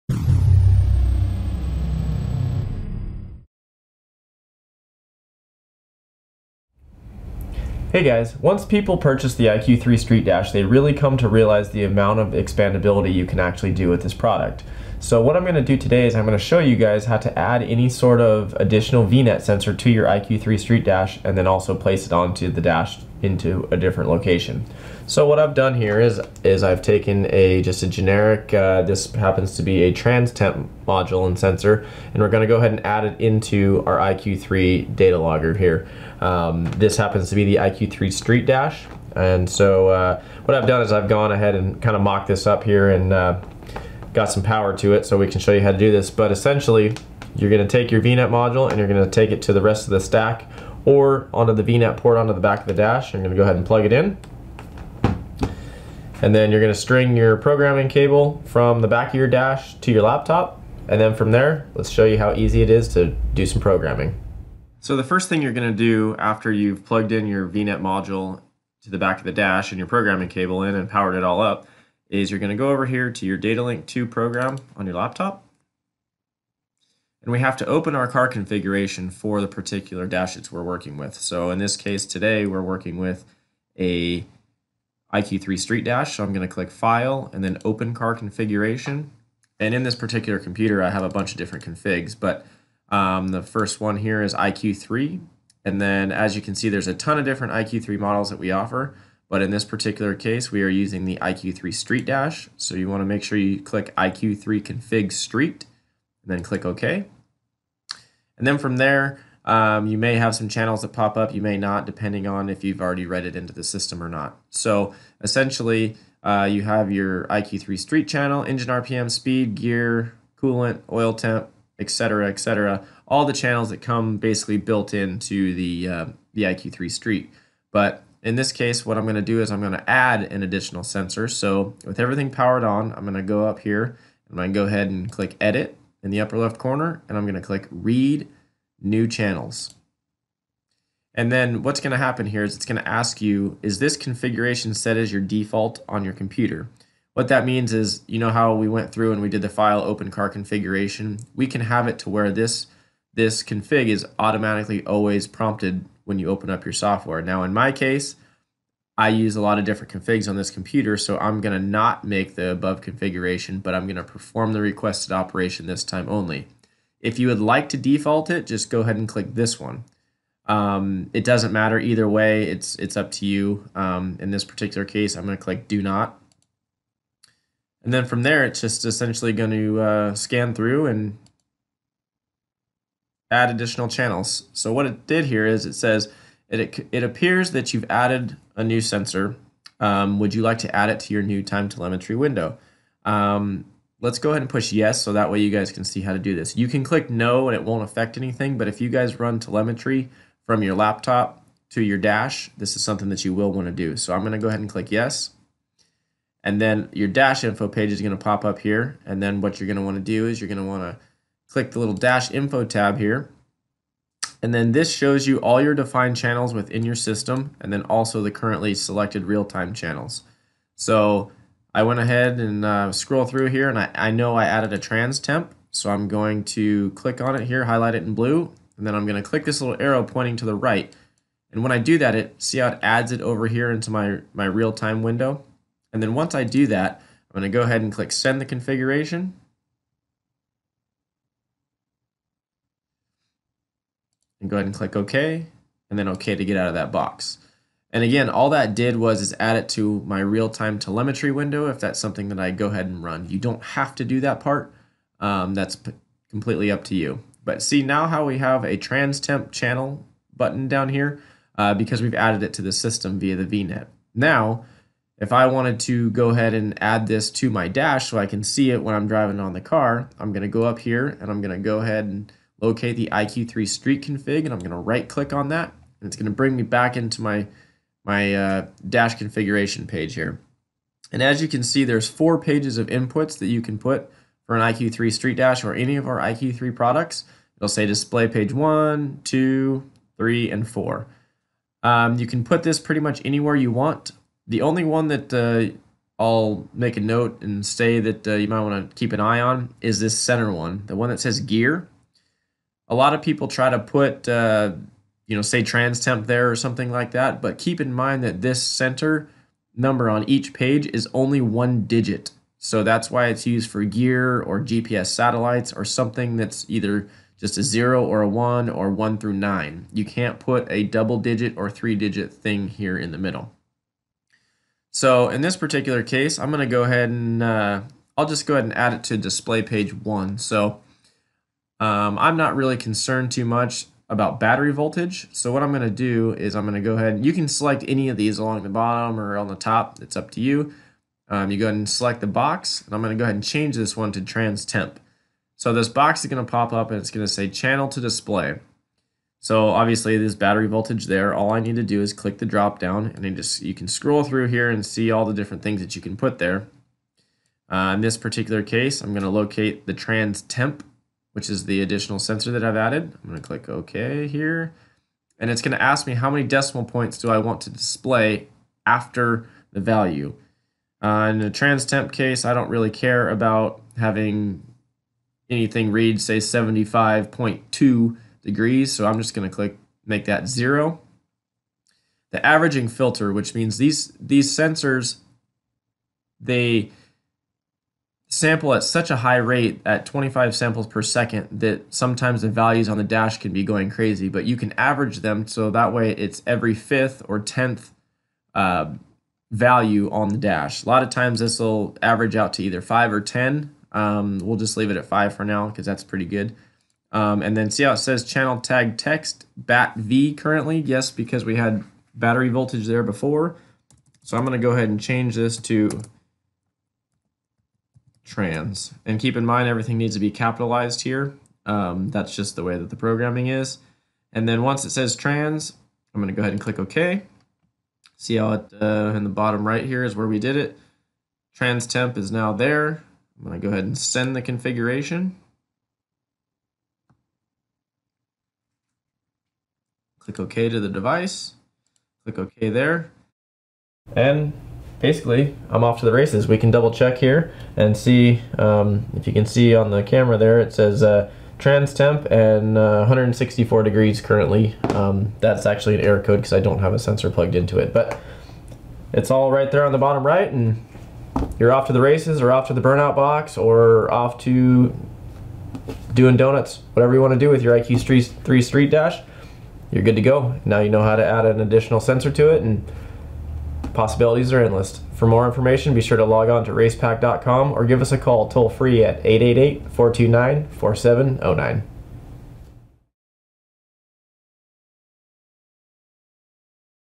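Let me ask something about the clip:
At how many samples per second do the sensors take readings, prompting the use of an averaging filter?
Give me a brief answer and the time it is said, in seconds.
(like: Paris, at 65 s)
25, at 390 s.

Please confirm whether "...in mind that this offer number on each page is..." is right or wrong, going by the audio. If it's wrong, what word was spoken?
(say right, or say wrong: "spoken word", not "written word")
wrong: "center", not "offer".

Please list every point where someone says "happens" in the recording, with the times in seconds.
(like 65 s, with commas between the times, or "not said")
29 s, 36 s, 141 s.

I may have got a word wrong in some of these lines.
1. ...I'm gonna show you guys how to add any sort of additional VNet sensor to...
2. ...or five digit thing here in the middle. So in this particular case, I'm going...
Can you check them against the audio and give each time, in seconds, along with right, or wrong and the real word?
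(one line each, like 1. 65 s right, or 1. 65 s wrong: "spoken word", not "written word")
1. 16 s right
2. 321 s wrong: "three", not "five".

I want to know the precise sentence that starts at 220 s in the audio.
So I went ahead and uh, scroll through here and I, I know I added a trans temp.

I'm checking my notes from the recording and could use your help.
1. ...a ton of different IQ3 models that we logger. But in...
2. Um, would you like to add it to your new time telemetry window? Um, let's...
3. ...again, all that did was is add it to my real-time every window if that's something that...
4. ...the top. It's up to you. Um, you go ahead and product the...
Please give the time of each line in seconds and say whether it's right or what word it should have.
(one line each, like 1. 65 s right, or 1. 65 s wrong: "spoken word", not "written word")
1. 96 s wrong: "offer", not "logger"
2. 189 s right
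3. 248 s wrong: "telemetry", not "every"
4. 339 s wrong: "select", not "product".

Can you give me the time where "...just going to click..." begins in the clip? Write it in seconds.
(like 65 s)
379 s.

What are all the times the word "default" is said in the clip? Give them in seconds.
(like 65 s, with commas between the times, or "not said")
145 s, 167 s.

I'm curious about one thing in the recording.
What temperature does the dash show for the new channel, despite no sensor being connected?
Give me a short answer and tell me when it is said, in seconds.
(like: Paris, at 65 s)
164 degrees, at 452 s.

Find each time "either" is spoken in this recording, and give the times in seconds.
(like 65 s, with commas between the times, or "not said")
171 s, 316 s, 402 s.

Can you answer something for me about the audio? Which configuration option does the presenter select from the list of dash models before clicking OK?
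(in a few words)
IQ3 Config Street.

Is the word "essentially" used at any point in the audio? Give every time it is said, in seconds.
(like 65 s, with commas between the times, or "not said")
46 s, 115 s, 178 s.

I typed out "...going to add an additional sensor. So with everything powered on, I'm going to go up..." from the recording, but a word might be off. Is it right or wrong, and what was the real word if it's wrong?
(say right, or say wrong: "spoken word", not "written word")
right.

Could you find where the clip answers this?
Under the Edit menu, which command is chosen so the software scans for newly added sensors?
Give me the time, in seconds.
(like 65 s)
137 s.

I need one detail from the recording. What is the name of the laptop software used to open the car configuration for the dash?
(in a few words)
Datalink 2.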